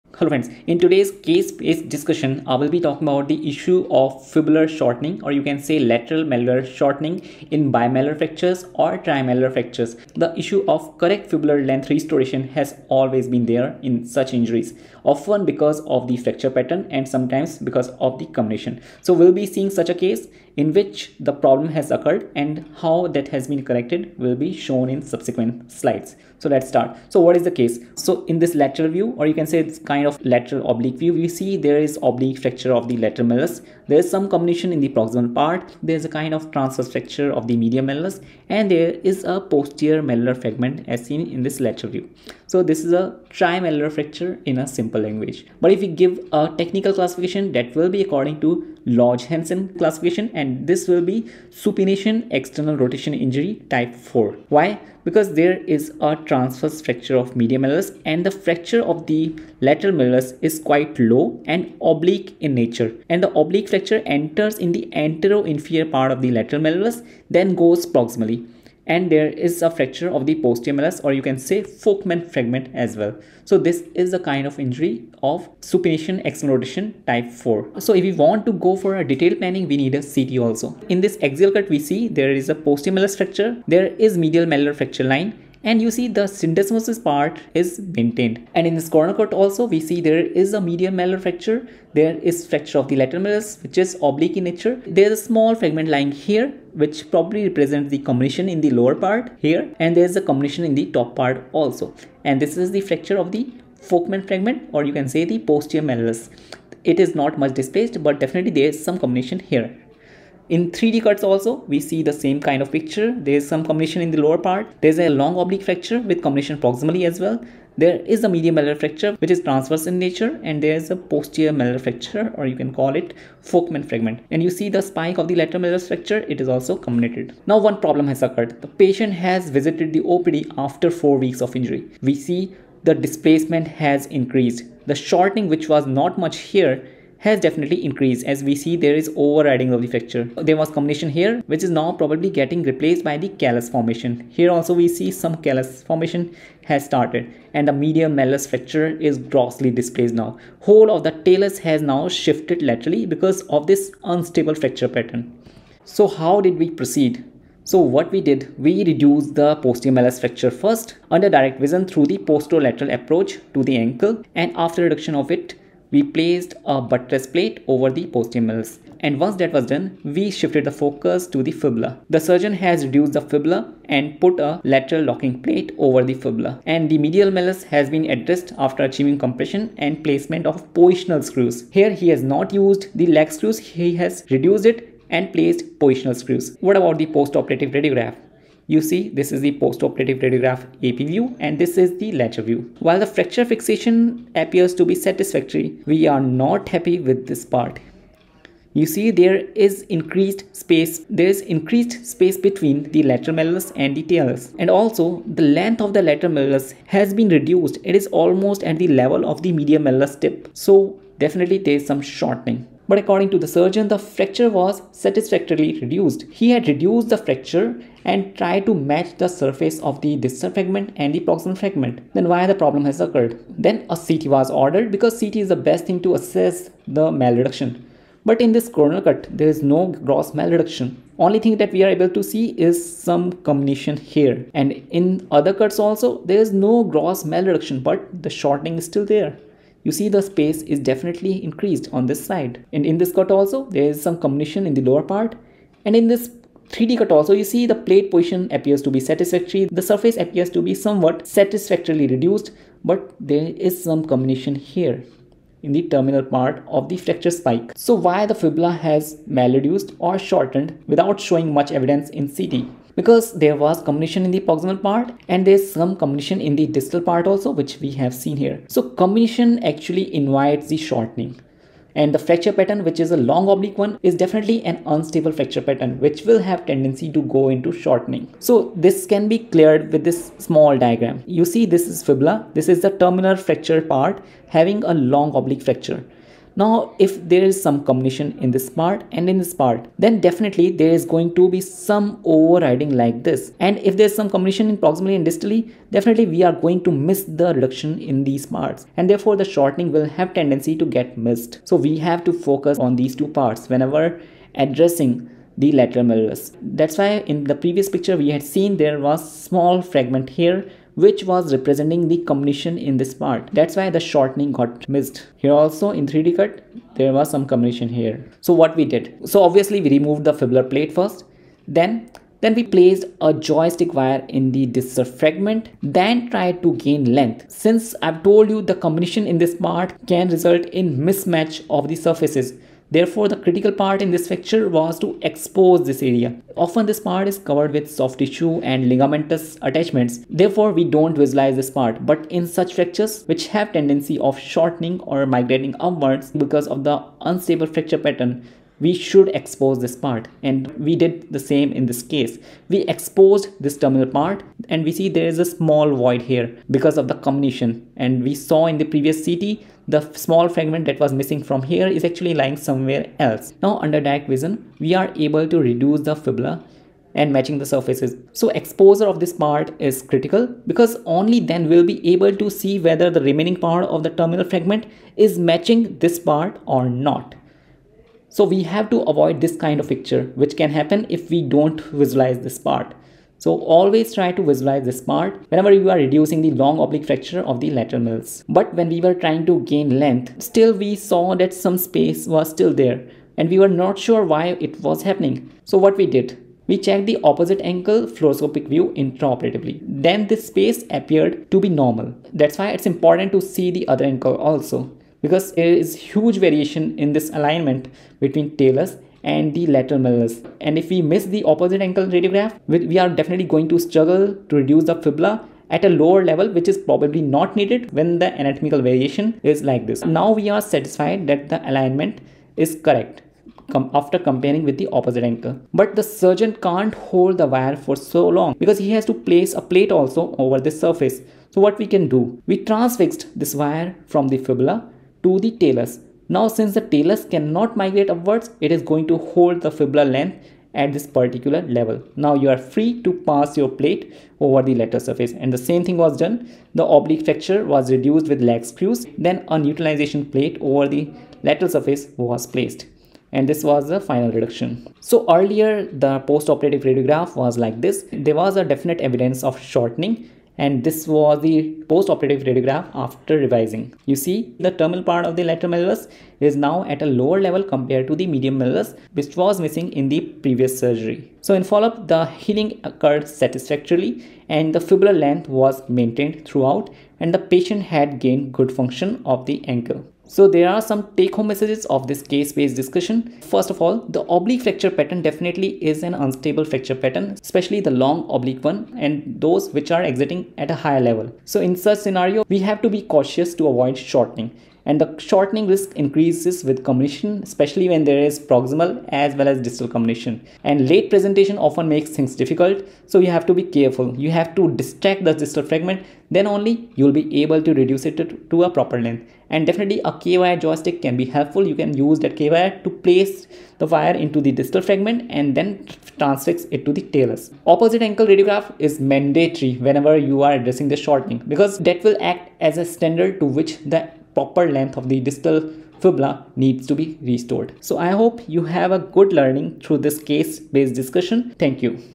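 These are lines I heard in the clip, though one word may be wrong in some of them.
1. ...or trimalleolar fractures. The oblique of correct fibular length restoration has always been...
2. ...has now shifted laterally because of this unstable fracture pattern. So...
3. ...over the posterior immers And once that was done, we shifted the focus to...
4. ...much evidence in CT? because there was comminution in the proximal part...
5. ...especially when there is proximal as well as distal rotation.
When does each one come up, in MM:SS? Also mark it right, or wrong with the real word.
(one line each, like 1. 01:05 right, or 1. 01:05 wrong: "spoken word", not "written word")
1. 00:08 wrong: "issue", not "oblique"
2. 02:31 right
3. 02:47 right
4. 04:21 right
5. 08:17 wrong: "comminution", not "rotation".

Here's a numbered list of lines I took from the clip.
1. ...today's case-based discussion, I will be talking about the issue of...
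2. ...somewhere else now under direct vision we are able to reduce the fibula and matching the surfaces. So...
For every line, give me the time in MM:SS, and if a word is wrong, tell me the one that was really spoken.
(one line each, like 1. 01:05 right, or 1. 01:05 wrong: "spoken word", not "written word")
1. 00:00 right
2. 06:02 right.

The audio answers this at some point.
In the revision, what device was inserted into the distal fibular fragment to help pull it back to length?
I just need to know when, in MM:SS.
05:23.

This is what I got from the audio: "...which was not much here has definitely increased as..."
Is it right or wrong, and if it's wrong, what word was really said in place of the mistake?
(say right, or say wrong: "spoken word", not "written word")
right.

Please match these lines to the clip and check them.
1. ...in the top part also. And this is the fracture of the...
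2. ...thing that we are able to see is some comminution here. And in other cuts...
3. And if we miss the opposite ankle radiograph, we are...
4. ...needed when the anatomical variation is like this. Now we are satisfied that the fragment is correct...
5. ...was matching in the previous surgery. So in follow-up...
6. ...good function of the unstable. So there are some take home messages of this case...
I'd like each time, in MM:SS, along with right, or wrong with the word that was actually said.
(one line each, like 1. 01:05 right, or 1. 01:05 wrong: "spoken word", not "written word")
1. 01:40 right
2. 03:51 right
3. 06:50 right
4. 06:57 wrong: "alignment", not "fragment"
5. 07:49 wrong: "missing", not "matching"
6. 07:58 wrong: "ankle", not "unstable".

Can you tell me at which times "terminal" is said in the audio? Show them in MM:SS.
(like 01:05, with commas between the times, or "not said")
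04:15, 04:42, 05:53, 06:14, 07:44.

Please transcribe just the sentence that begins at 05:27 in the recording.
Since I've told you the comminution in this part can result in mismatch of the surfaces.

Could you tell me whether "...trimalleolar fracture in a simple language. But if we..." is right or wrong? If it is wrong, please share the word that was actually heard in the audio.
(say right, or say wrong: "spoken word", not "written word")
right.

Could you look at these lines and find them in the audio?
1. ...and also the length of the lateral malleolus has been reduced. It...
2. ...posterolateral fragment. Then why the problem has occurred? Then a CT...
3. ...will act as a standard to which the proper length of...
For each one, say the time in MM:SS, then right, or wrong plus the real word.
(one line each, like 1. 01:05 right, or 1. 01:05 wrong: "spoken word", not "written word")
1. 03:24 right
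2. 03:41 wrong: "proximal", not "posterolateral"
3. 08:42 right.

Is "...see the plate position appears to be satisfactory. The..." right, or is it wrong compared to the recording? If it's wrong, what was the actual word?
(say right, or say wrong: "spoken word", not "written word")
right.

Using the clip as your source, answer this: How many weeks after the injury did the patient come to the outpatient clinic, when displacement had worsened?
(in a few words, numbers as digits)
4 weeks.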